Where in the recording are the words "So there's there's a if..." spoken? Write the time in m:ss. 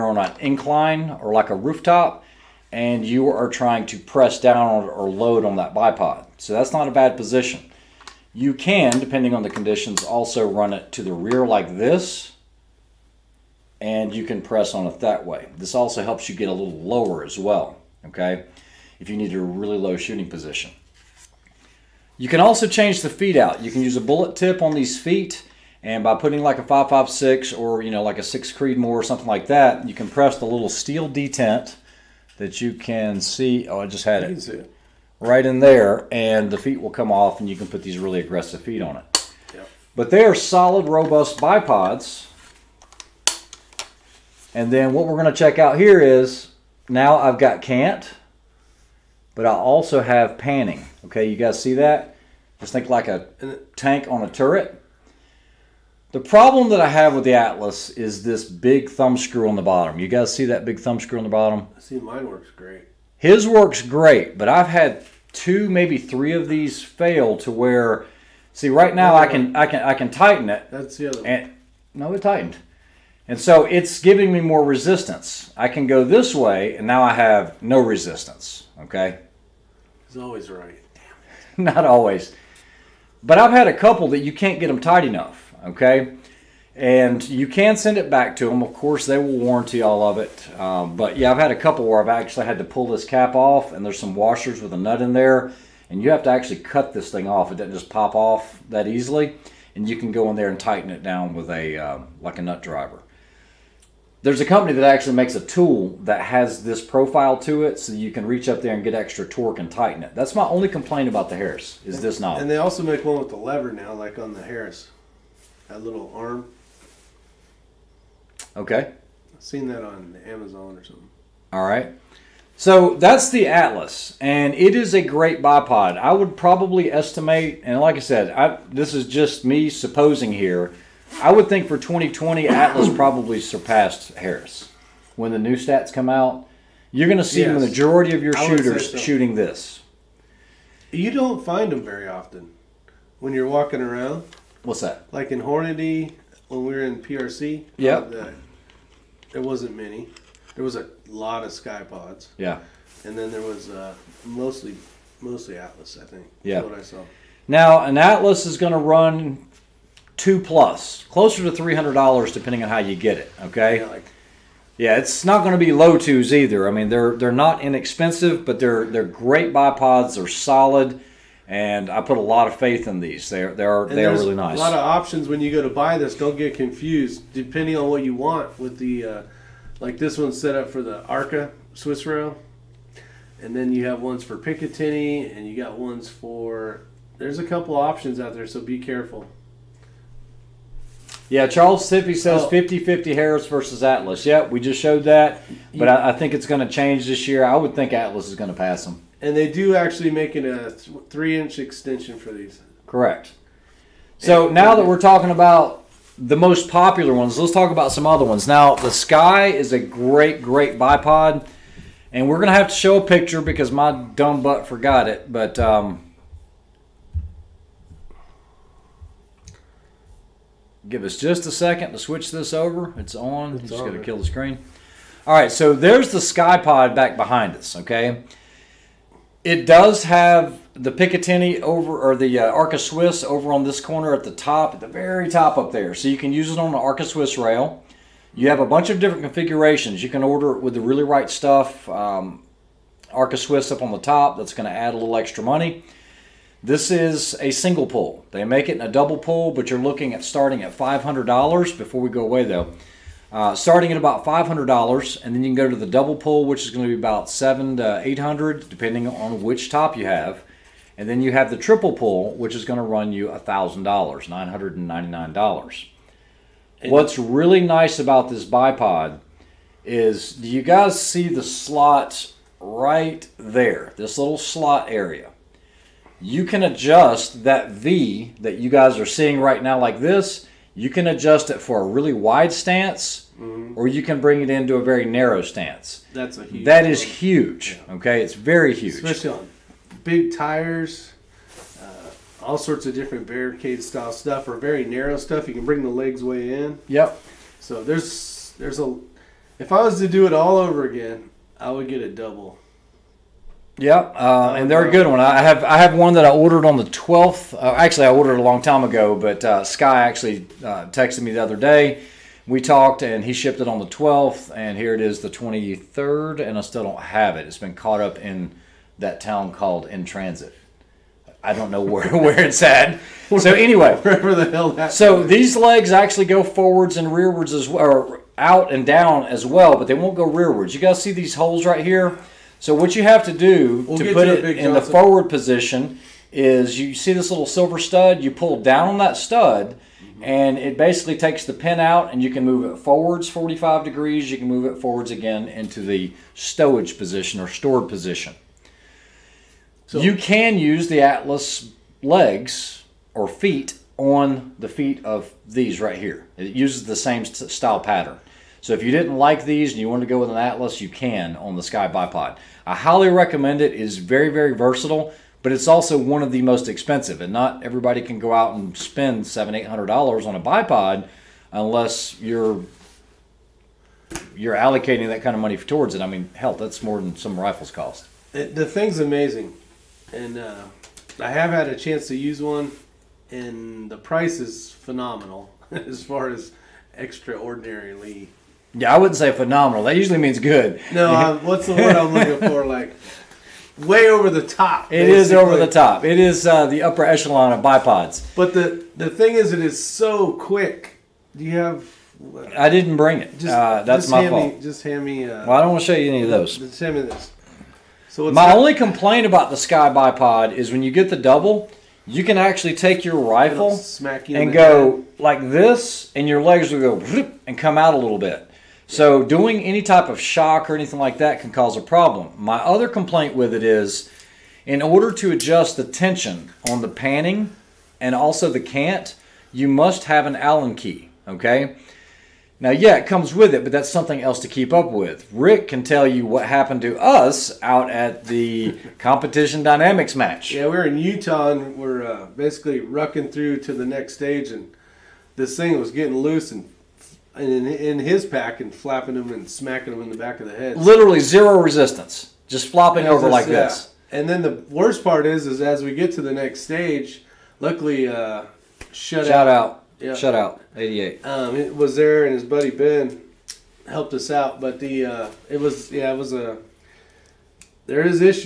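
4:57.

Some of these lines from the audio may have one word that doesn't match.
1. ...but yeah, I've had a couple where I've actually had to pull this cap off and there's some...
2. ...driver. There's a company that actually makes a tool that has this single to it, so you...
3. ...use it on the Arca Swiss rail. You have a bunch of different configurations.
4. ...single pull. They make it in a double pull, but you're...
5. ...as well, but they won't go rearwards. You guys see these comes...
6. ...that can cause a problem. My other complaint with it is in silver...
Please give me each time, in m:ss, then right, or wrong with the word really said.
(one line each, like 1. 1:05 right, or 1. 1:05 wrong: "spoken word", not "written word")
1. 1:30 right
2. 1:42 wrong: "profile", not "single"
3. 3:56 right
4. 4:07 right
5. 5:29 wrong: "holes", not "comes"
6. 7:01 wrong: "order", not "silver".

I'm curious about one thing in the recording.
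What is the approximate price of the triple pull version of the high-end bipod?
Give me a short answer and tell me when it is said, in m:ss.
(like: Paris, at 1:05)
$999, at 4:23.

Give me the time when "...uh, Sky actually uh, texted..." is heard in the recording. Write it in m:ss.
5:09.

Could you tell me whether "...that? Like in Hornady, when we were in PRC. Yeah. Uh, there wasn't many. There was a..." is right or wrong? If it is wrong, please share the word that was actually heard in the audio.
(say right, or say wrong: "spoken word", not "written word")
right.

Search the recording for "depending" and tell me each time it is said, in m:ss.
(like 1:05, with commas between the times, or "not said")
0:08, 2:42, 2:57, 4:18.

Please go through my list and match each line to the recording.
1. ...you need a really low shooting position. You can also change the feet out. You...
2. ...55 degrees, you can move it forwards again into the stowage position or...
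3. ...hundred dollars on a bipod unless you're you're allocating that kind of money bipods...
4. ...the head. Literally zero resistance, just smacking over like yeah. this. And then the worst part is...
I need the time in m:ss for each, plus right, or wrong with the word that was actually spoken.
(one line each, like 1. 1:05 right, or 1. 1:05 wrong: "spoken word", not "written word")
1. 0:19 right
2. 5:43 wrong: "45", not "55"
3. 6:09 wrong: "towards", not "bipods"
4. 7:30 wrong: "flopping", not "smacking".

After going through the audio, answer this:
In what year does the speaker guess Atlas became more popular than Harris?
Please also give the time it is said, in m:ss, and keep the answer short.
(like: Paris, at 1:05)
2020, at 2:11.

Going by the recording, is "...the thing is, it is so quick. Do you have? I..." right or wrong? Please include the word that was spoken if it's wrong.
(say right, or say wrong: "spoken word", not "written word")
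right.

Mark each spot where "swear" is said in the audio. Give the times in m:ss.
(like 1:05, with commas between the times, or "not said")
not said.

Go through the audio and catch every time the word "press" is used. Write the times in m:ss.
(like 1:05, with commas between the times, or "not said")
0:03, 0:14, 0:30.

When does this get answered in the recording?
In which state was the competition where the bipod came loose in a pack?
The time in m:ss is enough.
7:20.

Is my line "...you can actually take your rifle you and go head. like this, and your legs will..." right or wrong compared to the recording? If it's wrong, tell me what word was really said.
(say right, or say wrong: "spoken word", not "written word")
right.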